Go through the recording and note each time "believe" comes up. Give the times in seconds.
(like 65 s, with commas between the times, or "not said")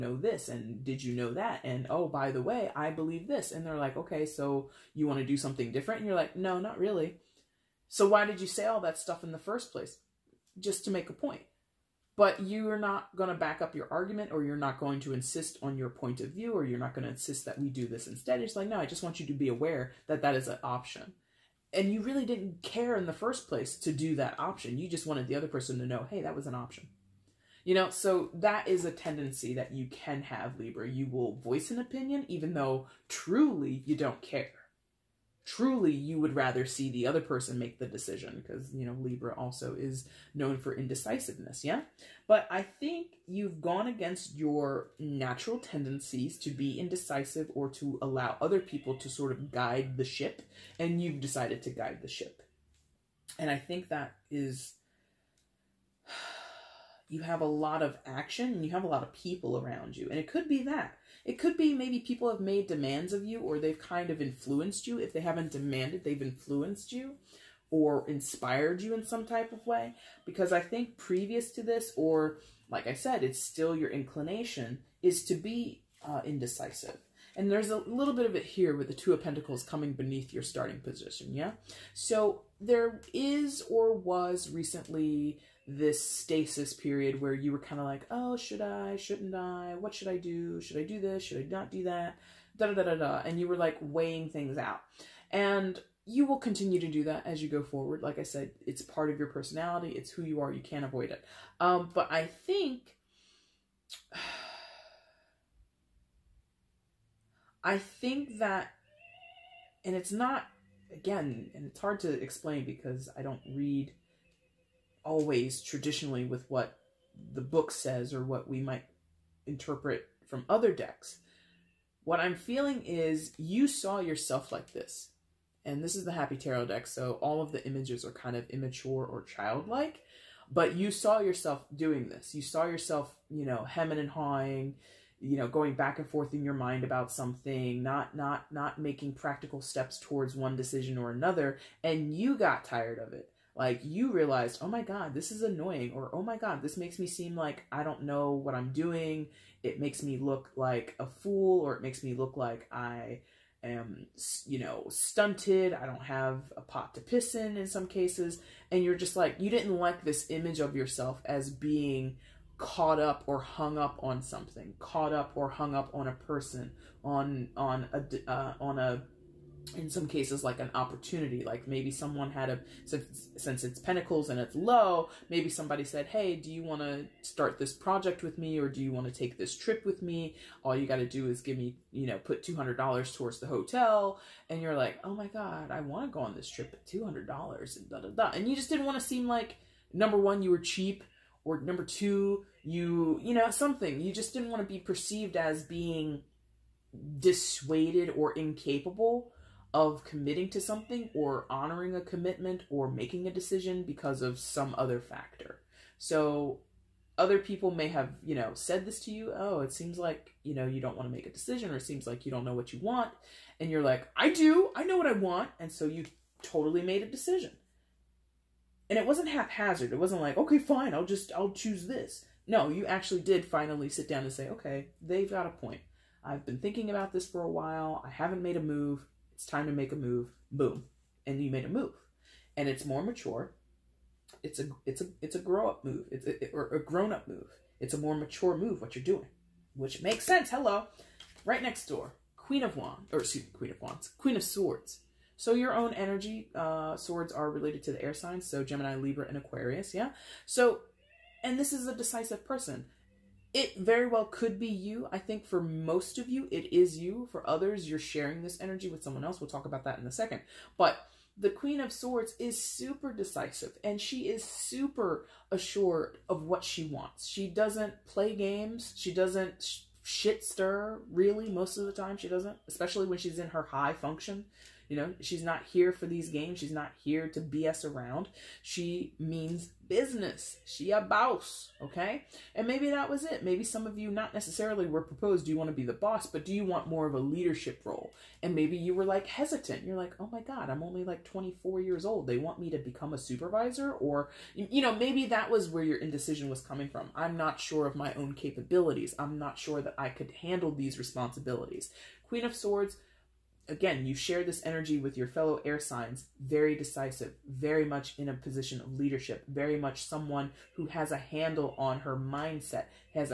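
2 s.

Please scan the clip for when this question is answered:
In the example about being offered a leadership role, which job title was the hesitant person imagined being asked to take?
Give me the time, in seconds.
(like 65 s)
293 s.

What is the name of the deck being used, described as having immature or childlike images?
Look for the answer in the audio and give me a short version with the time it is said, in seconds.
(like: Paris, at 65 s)
Happy Tarot, at 126 s.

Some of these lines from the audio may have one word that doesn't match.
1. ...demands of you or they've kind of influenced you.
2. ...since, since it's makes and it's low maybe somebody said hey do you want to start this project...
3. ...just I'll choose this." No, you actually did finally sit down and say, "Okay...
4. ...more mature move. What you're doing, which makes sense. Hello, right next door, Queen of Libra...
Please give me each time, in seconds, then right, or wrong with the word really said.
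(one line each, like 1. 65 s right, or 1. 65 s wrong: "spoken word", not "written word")
1. 62 s right
2. 172 s wrong: "pentacles", not "makes"
3. 221 s right
4. 237 s wrong: "Wands", not "Libra".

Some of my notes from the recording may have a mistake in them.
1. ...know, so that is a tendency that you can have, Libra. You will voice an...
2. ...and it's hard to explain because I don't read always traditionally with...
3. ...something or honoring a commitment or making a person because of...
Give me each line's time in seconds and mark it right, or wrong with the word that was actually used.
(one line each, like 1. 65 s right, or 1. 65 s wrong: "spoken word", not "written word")
1. 27 s right
2. 111 s right
3. 200 s wrong: "decision", not "person".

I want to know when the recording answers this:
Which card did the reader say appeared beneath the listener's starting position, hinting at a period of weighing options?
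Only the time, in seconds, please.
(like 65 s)
78 s.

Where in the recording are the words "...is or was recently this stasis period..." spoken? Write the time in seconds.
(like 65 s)
83 s.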